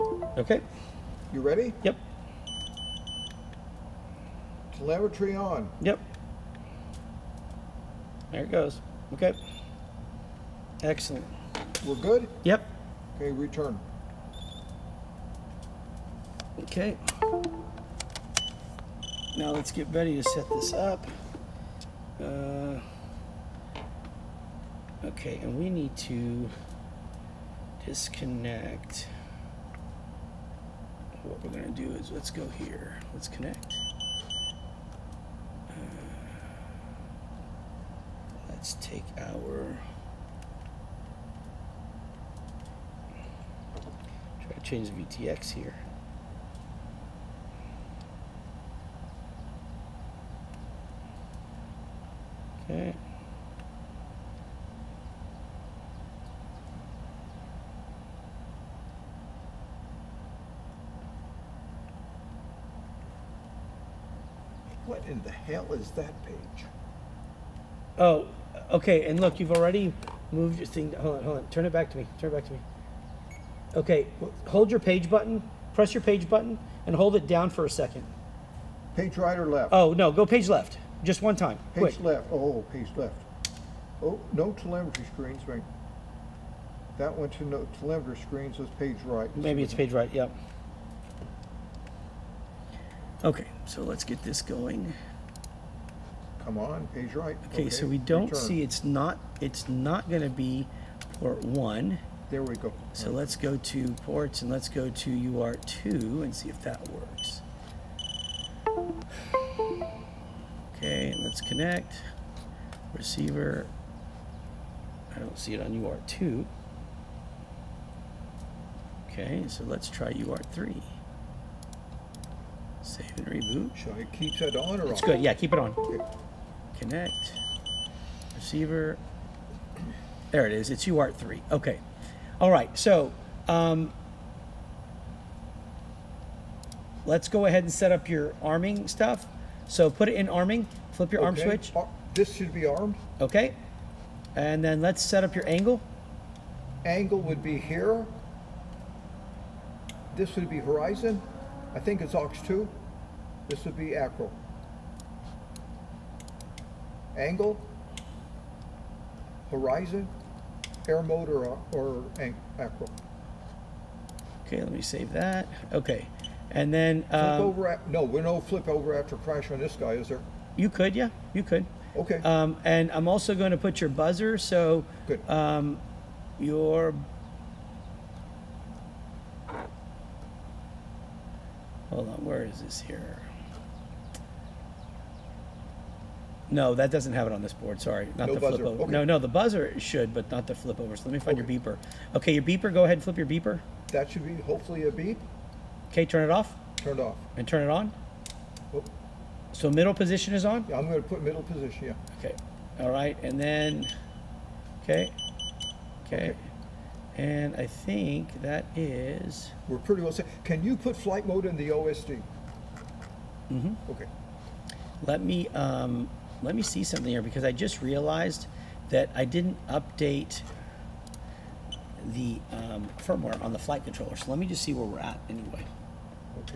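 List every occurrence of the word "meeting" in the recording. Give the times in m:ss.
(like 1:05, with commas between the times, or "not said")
not said.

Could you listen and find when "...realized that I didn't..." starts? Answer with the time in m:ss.
3:37.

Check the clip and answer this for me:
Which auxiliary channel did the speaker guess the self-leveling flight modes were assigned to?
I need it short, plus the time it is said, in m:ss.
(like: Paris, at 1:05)
aux 2, at 2:32.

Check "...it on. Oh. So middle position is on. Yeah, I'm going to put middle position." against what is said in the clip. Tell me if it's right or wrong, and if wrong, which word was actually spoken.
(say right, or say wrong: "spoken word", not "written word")
right.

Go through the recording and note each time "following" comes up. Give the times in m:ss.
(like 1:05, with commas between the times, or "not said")
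not said.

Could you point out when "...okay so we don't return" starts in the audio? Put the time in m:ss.
1:37.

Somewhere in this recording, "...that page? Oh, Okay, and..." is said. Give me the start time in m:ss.
1:05.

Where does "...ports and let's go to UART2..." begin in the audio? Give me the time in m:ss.
1:44.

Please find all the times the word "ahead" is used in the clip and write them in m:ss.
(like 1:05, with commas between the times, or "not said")
2:17, 3:12.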